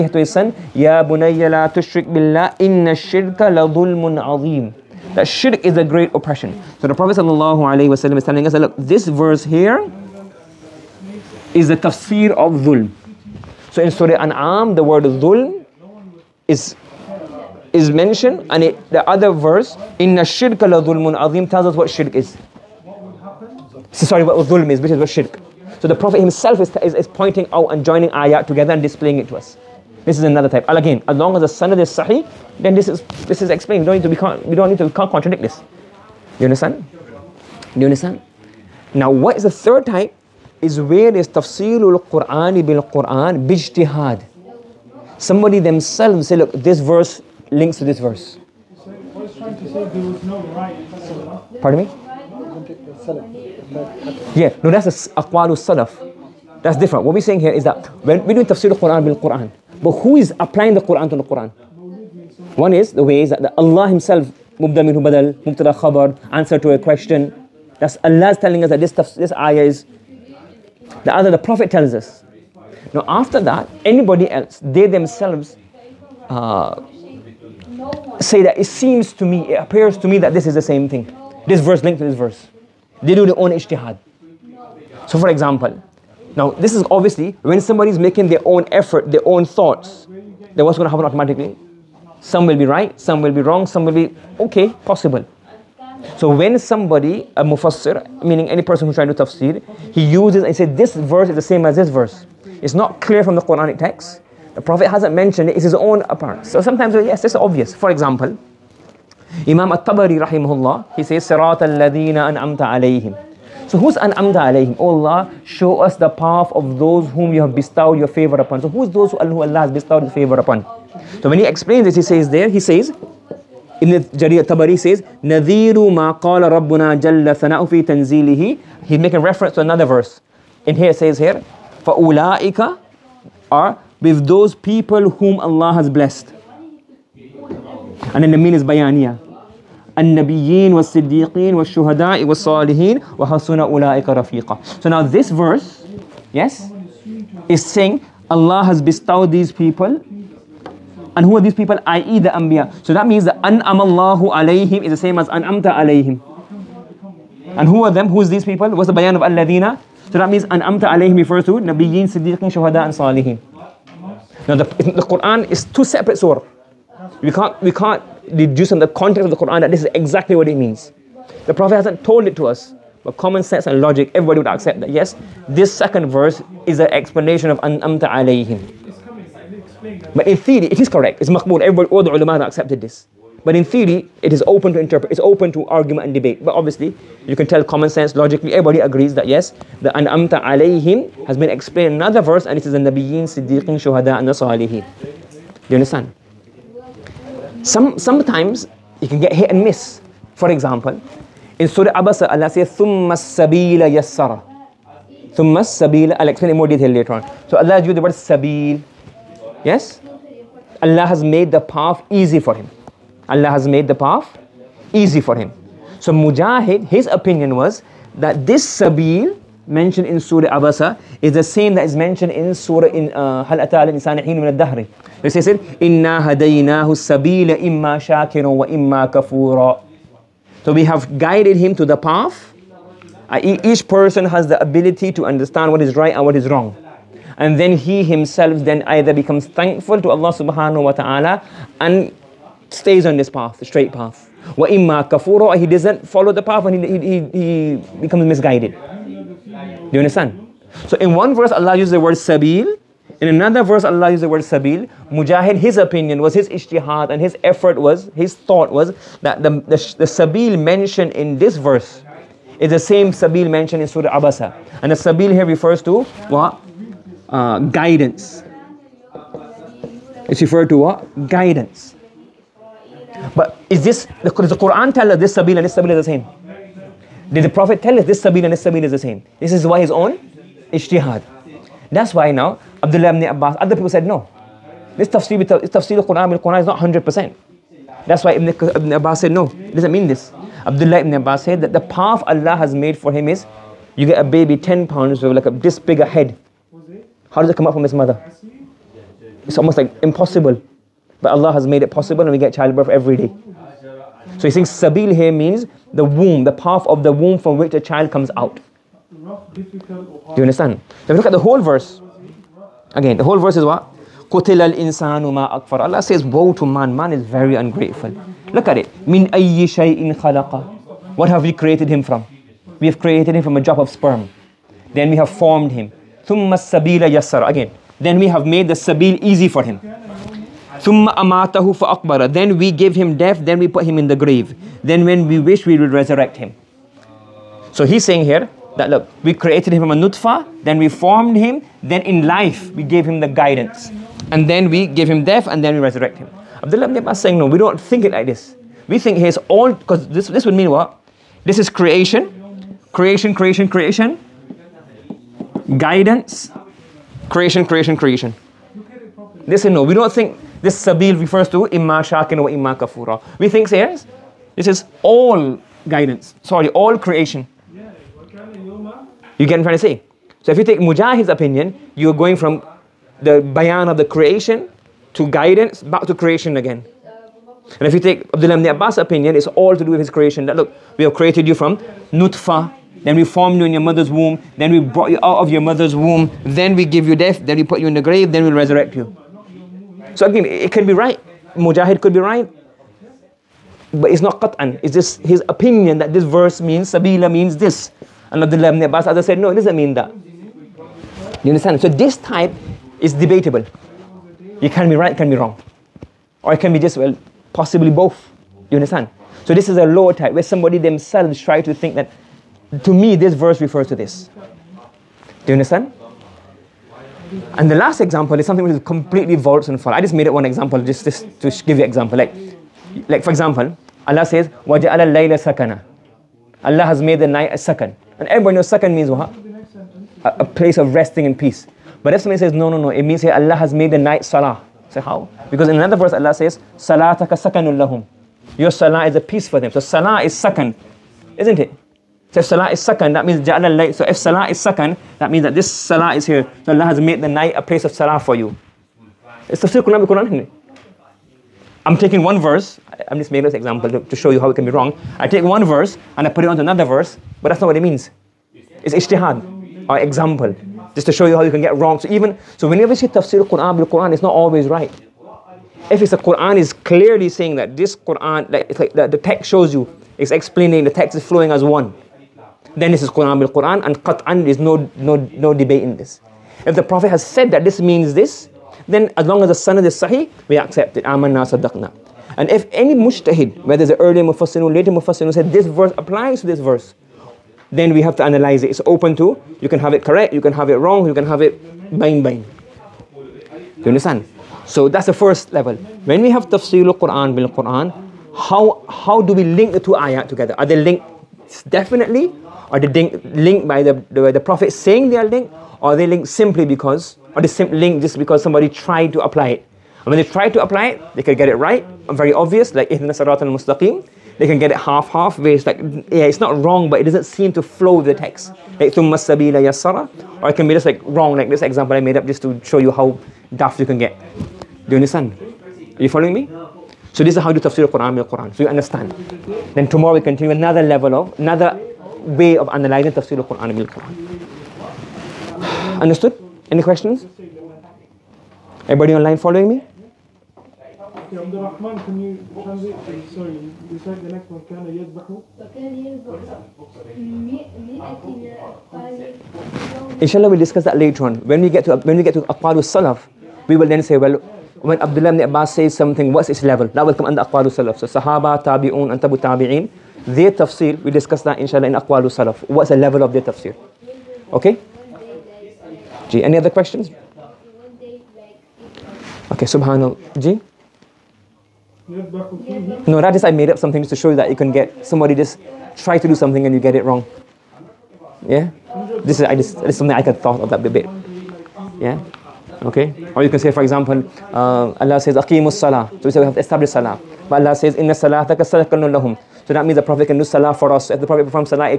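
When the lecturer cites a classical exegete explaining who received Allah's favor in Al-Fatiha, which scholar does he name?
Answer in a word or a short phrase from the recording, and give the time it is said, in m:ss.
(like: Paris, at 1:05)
Imam At-Tabari, at 1:49.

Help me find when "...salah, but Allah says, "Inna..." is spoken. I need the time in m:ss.
9:46.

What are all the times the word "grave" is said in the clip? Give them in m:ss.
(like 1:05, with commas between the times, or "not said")
5:34, 6:28.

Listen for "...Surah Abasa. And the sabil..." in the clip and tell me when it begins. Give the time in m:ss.
4:23.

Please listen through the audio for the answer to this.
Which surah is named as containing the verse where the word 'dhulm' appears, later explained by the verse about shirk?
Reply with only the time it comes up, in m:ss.
0:13.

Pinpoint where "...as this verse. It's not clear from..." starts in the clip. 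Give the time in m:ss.
1:41.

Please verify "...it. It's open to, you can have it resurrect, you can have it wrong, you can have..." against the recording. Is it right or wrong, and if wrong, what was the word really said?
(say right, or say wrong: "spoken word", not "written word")
wrong: "correct", not "resurrect".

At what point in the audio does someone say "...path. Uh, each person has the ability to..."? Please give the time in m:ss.
3:51.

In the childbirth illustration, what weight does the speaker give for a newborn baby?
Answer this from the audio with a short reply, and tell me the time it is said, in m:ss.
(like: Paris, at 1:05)
10 pounds, at 4:54.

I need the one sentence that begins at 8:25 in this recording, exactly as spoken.
Or are they linked simply because, or they simply linked just because somebody tried to apply it?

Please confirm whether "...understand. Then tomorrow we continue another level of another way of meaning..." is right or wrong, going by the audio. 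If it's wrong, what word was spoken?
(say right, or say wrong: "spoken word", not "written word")
wrong: "analyzing", not "meaning".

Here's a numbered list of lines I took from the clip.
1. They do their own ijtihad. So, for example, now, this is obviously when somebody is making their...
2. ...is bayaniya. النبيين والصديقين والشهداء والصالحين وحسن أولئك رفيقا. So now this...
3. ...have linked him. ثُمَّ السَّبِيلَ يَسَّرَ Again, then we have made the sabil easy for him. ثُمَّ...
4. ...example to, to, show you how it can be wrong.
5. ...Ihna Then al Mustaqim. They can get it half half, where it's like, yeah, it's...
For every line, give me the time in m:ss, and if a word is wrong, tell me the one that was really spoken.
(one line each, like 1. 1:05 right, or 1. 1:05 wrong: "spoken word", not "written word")
1. 1:23 right
2. 2:18 right
3. 5:25 wrong: "formed", not "linked"
4. 7:33 right
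5. 8:32 wrong: "Sarat", not "Then".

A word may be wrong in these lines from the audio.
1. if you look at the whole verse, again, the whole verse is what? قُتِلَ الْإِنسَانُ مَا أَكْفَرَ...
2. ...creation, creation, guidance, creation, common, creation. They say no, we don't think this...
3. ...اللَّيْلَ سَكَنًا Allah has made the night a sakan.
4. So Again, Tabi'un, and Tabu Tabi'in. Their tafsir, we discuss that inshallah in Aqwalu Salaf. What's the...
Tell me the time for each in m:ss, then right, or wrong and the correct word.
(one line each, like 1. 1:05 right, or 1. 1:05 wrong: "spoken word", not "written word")
1. 5:11 right
2. 5:53 wrong: "creation", not "common"
3. 7:04 right
4. 9:17 wrong: "Sahaba", not "Again".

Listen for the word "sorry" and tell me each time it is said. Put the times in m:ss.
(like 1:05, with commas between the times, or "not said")
0:24, 6:06, 9:03.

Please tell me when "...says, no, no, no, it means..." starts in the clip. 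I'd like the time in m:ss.
7:12.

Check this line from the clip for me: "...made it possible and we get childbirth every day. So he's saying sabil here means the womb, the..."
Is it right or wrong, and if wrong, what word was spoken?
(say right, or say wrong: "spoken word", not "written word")
right.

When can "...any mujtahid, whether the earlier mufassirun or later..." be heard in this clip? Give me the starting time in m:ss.
8:02.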